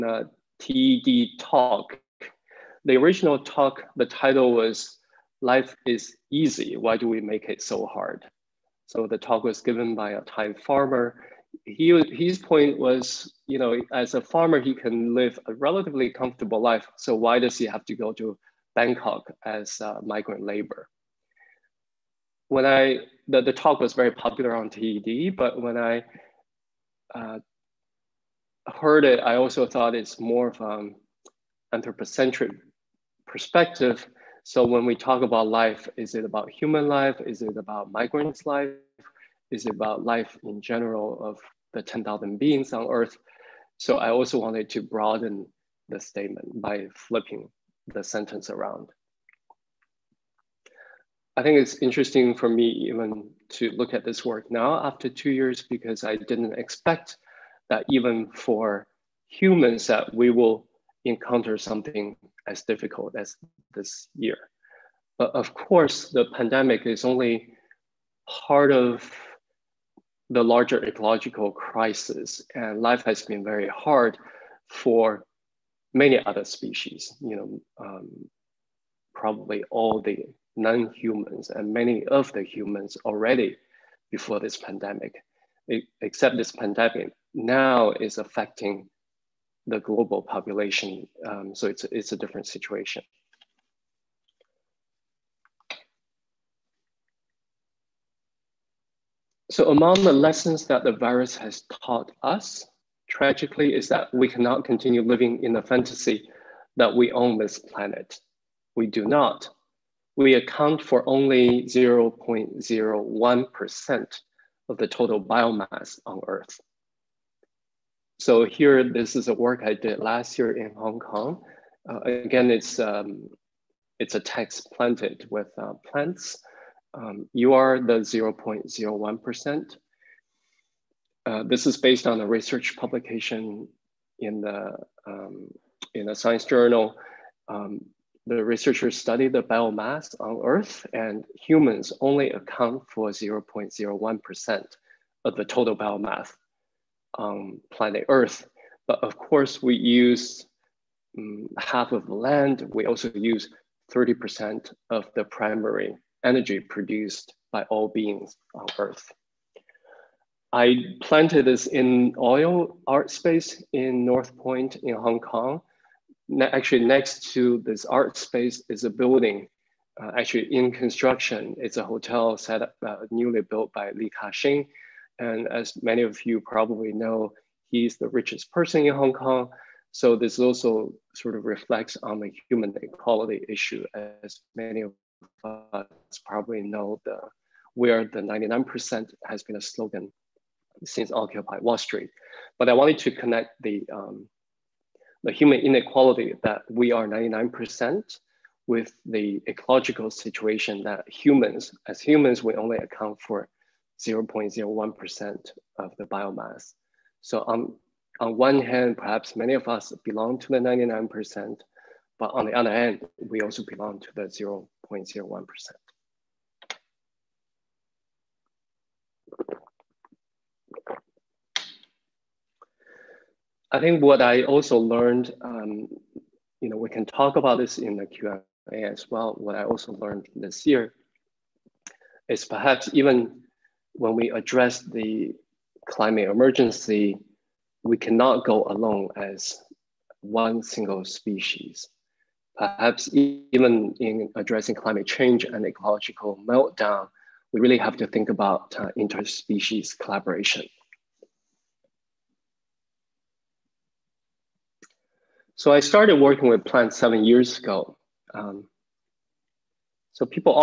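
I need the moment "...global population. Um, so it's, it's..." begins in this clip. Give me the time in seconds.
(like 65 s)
89 s.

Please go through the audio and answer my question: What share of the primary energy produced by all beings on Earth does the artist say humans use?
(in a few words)
30%.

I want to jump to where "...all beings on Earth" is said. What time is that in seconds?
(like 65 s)
157 s.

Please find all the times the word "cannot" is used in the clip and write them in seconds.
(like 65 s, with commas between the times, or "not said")
104 s, 237 s.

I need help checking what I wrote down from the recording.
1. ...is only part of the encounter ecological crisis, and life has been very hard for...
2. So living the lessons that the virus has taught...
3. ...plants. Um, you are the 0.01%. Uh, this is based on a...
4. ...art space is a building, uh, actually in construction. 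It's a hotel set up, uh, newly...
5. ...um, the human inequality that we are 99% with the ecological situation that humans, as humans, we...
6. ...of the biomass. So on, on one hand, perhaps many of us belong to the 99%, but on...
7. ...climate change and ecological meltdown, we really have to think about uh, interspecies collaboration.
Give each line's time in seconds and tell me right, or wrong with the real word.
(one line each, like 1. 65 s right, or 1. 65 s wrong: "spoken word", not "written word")
1. 66 s wrong: "larger", not "encounter"
2. 99 s wrong: "among", not "living"
3. 125 s right
4. 167 s right
5. 193 s right
6. 205 s right
7. 244 s right.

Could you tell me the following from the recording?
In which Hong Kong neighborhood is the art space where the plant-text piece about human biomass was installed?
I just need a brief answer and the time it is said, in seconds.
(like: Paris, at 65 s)
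North Point, at 164 s.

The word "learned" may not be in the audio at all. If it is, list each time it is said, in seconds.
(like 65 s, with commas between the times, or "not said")
224 s, 229 s.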